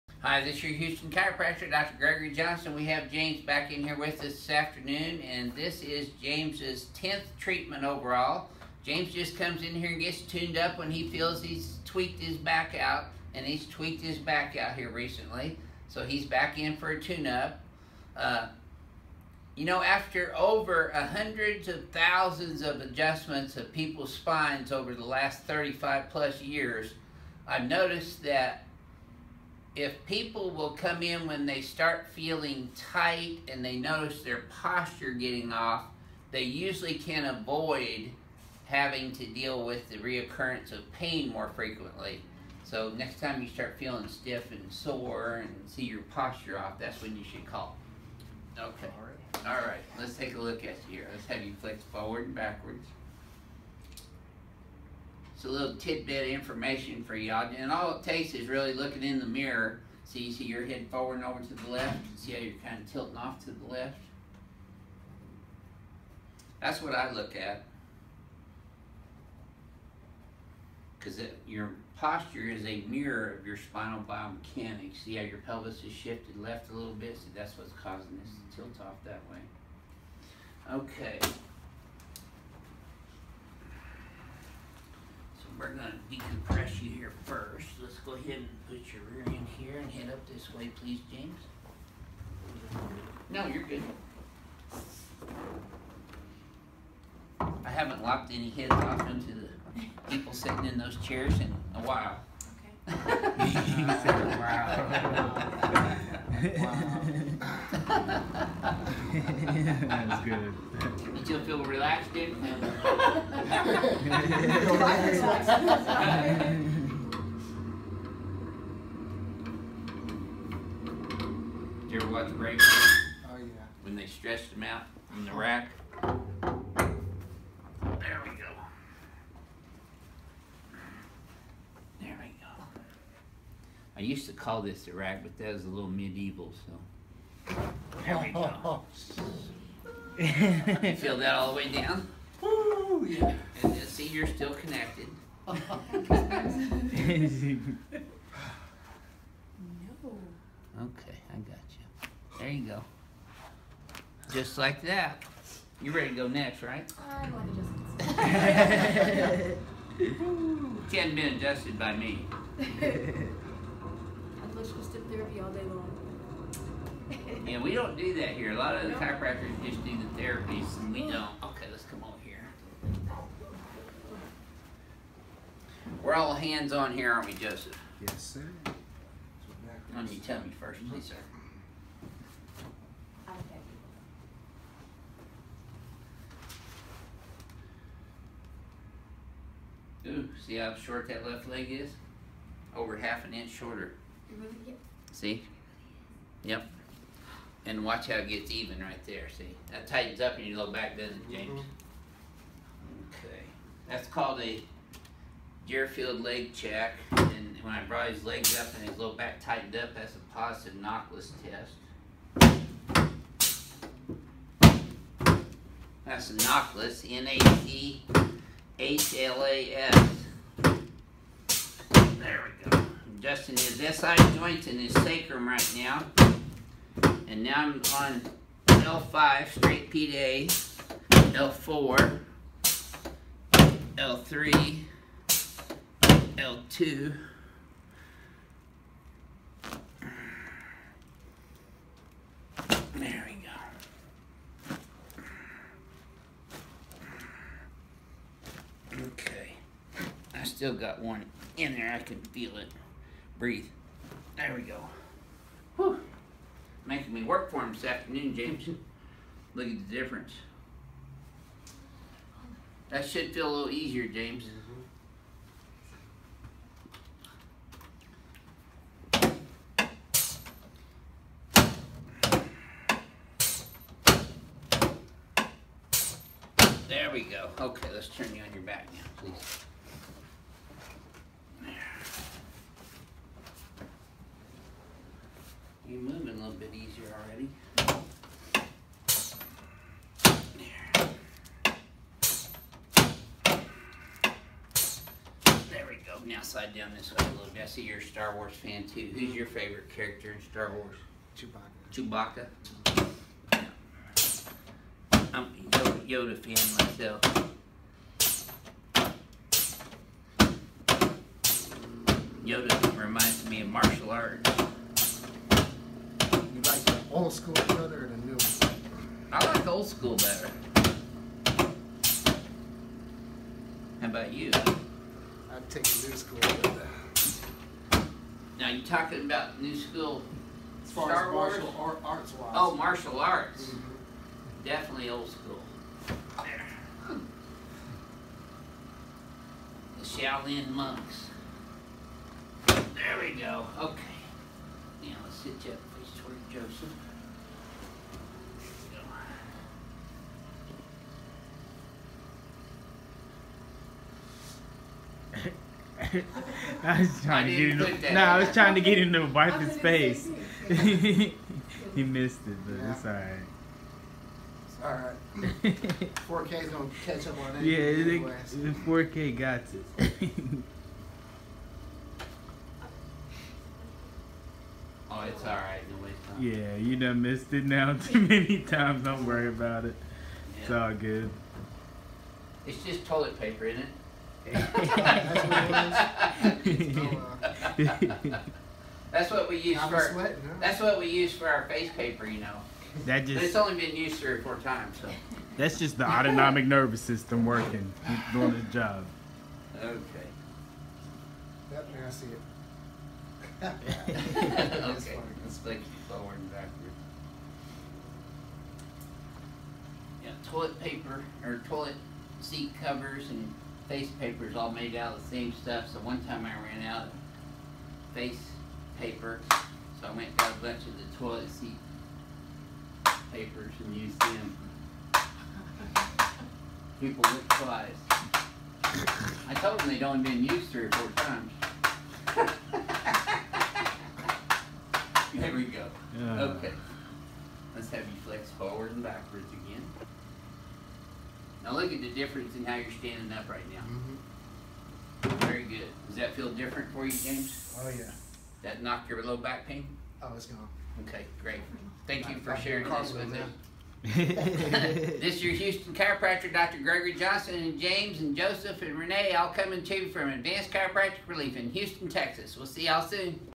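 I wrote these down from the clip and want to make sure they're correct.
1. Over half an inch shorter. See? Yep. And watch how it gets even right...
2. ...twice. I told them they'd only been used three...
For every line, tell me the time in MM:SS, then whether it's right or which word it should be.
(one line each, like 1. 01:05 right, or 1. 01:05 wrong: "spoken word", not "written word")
1. 03:12 right
2. 07:07 right.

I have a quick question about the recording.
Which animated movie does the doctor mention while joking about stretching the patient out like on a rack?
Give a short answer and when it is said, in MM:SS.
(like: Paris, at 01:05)
Brave, at 02:02.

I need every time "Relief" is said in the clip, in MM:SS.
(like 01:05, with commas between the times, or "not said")
07:41.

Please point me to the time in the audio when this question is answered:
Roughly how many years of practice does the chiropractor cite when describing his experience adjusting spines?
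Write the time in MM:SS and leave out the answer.
00:25.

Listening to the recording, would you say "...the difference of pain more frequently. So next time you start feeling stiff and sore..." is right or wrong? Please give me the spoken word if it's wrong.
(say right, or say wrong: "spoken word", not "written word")
wrong: "reoccurrence", not "difference".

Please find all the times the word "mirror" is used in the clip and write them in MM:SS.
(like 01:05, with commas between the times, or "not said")
00:59, 01:12.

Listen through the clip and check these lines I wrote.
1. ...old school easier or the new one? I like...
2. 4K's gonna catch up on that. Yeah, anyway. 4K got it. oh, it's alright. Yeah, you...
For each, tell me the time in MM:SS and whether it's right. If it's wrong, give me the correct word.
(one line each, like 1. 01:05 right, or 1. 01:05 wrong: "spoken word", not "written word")
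1. 05:17 wrong: "shredder", not "easier"
2. 06:06 right.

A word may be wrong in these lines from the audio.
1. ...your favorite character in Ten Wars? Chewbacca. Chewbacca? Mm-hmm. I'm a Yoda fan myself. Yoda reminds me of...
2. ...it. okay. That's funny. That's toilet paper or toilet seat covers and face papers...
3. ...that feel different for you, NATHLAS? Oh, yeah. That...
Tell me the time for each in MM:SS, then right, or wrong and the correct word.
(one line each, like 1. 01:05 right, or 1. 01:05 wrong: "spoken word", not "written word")
1. 04:59 wrong: "Star", not "Ten"
2. 06:43 right
3. 07:26 wrong: "James", not "NATHLAS".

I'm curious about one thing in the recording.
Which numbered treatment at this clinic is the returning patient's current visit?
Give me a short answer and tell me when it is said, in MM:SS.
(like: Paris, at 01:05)
10th, at 00:06.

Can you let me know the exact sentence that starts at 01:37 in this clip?
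I haven't locked any heads off into the people sitting in those chairs in a while he said, wow.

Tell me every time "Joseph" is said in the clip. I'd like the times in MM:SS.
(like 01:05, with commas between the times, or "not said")
02:57, 05:46, 07:38.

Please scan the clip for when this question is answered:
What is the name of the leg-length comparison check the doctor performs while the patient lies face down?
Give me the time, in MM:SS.
03:25.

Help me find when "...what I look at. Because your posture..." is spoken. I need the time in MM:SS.
01:06.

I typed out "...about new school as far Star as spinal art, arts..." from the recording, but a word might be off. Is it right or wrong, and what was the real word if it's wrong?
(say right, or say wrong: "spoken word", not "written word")
wrong: "martial", not "spinal".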